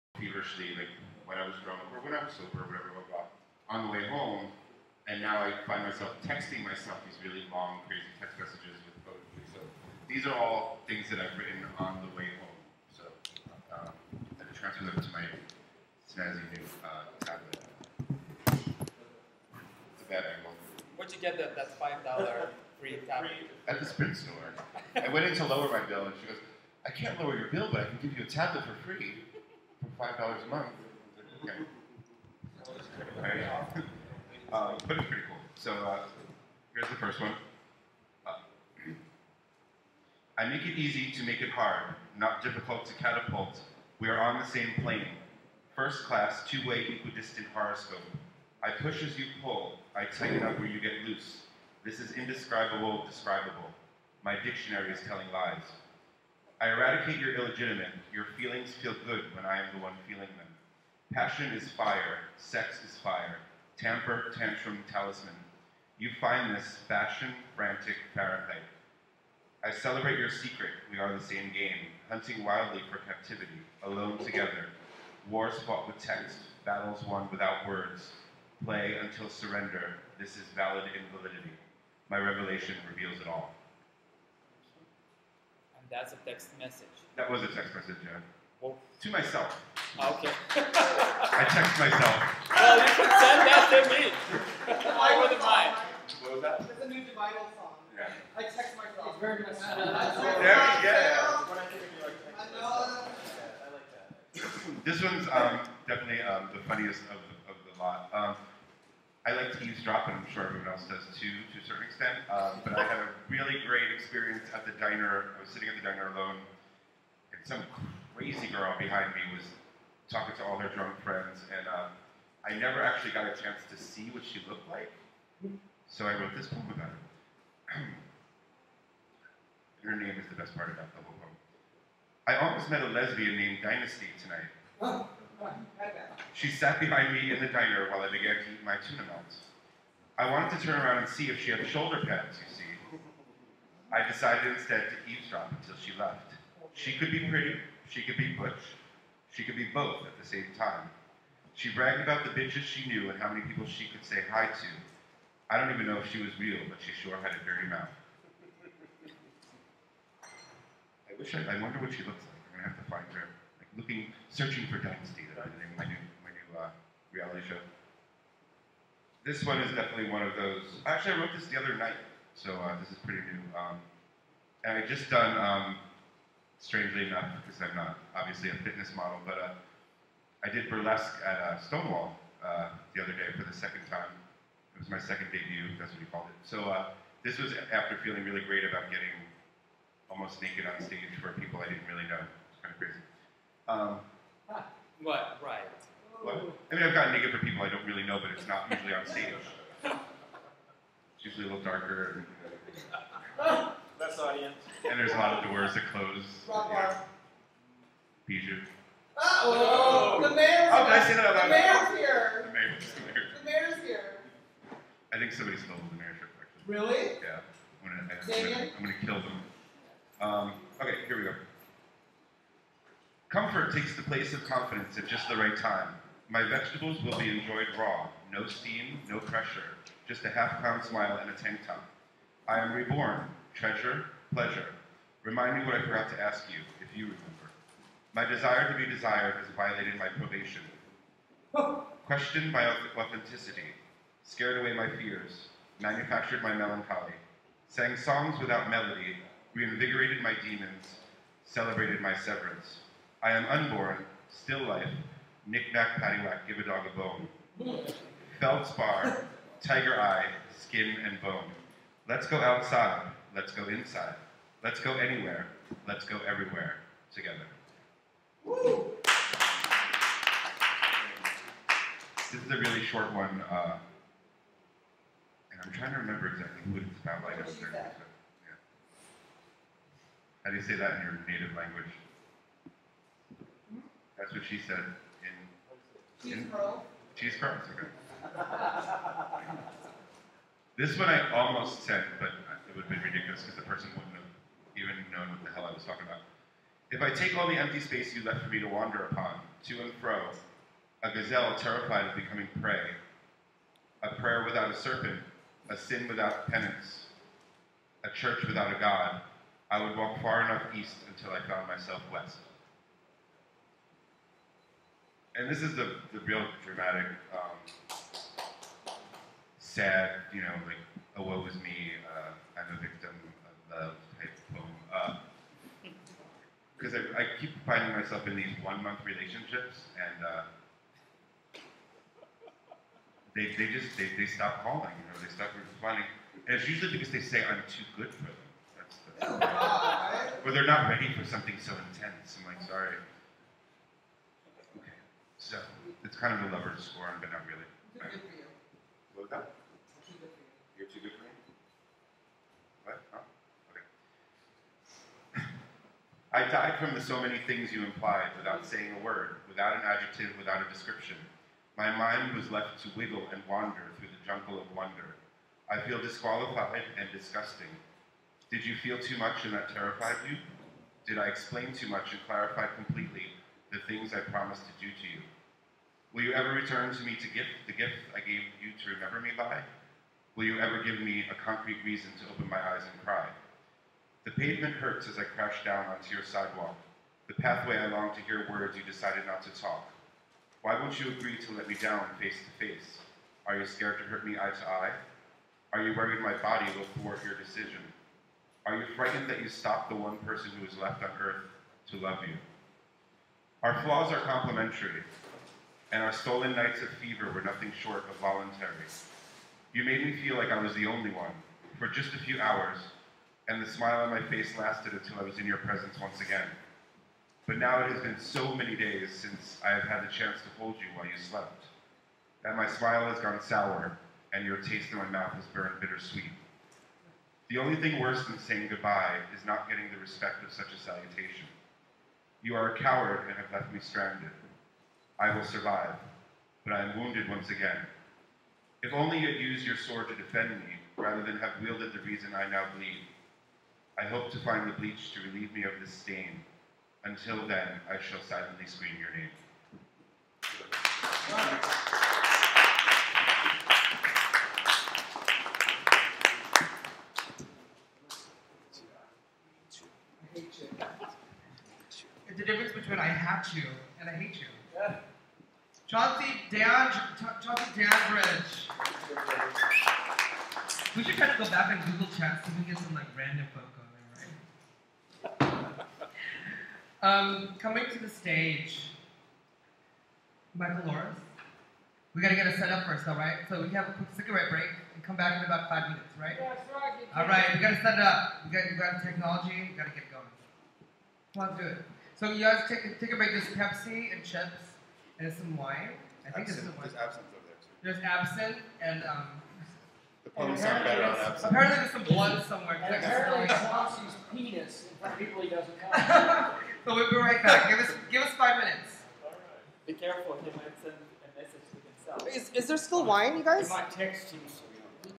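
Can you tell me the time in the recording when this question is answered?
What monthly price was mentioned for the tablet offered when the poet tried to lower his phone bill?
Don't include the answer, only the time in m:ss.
0:30.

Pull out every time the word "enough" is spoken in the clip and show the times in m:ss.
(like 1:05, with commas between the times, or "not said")
2:57, 5:10.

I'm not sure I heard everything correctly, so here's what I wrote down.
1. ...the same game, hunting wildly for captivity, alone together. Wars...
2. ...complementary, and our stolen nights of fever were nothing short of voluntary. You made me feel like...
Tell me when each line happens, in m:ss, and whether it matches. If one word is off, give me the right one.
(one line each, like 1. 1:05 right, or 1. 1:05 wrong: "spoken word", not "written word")
1. 1:11 right
2. 6:44 right.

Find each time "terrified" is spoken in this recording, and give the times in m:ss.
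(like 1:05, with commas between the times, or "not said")
5:01, 6:09.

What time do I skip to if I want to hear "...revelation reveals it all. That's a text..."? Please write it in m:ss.
1:22.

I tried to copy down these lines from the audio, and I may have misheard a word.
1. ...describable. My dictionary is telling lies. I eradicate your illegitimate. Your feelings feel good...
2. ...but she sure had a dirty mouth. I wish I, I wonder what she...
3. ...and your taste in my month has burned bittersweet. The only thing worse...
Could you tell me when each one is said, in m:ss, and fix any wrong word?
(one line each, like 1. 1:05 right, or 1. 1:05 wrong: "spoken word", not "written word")
1. 0:53 right
2. 2:36 right
3. 7:04 wrong: "mouth", not "month".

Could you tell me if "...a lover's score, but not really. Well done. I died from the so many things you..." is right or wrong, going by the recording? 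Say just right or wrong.
right.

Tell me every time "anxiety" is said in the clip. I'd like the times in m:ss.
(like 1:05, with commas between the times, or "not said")
not said.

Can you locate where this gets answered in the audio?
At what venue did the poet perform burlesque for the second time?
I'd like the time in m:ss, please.
3:01.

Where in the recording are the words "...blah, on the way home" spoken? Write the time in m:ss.
0:03.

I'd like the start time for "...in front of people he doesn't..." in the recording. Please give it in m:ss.
8:24.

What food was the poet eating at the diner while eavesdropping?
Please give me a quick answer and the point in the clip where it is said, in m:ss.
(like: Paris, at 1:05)
tuna melts, at 2:18.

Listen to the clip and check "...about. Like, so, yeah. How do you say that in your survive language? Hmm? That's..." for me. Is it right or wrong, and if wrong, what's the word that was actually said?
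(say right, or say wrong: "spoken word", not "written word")
wrong: "native", not "survive".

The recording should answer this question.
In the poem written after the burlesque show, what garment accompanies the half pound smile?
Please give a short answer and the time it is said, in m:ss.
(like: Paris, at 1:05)
tank top, at 3:51.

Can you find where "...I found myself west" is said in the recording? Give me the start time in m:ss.
5:11.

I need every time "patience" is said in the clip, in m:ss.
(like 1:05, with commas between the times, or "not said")
not said.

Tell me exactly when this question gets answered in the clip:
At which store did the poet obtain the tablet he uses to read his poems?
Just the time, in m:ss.
0:23.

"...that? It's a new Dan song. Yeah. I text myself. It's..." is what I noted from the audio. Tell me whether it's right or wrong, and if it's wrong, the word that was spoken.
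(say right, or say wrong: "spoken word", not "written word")
wrong: "Dividal", not "Dan".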